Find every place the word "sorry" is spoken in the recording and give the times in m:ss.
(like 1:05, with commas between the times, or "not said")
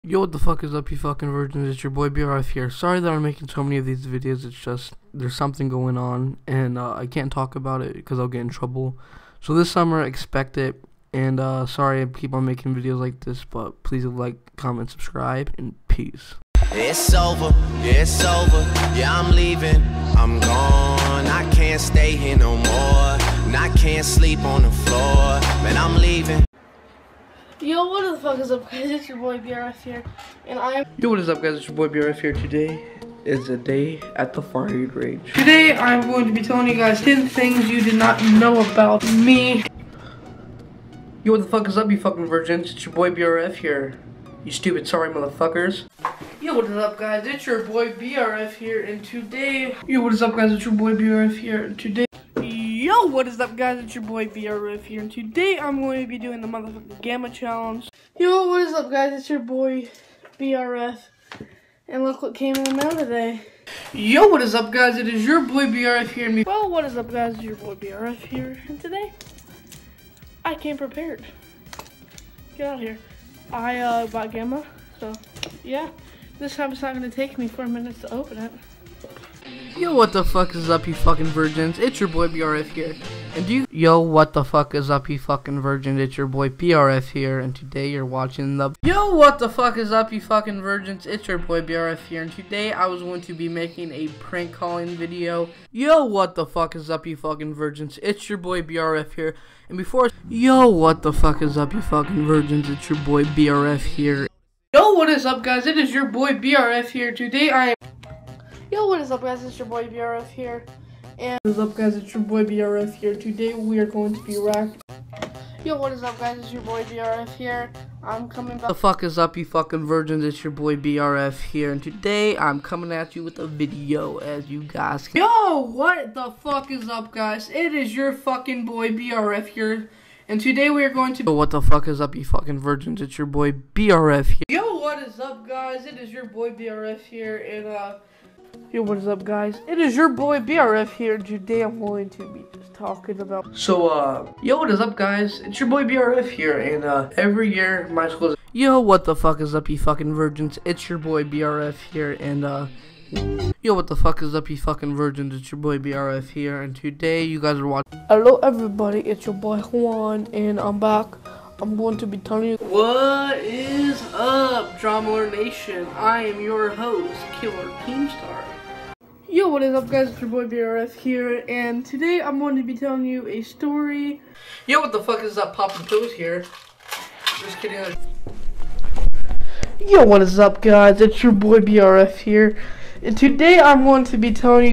0:02, 0:11, 0:44.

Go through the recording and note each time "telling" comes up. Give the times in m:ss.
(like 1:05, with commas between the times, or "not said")
0:36, 2:42, 2:52, 3:04.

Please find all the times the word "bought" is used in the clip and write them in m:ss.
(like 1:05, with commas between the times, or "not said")
1:14.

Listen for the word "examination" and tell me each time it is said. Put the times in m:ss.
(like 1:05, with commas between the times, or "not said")
not said.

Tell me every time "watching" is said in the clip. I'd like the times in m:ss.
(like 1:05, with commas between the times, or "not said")
1:28, 2:37.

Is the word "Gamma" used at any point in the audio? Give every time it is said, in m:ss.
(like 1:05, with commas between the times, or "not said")
0:57, 1:14.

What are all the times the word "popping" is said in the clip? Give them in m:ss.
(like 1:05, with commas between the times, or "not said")
2:55.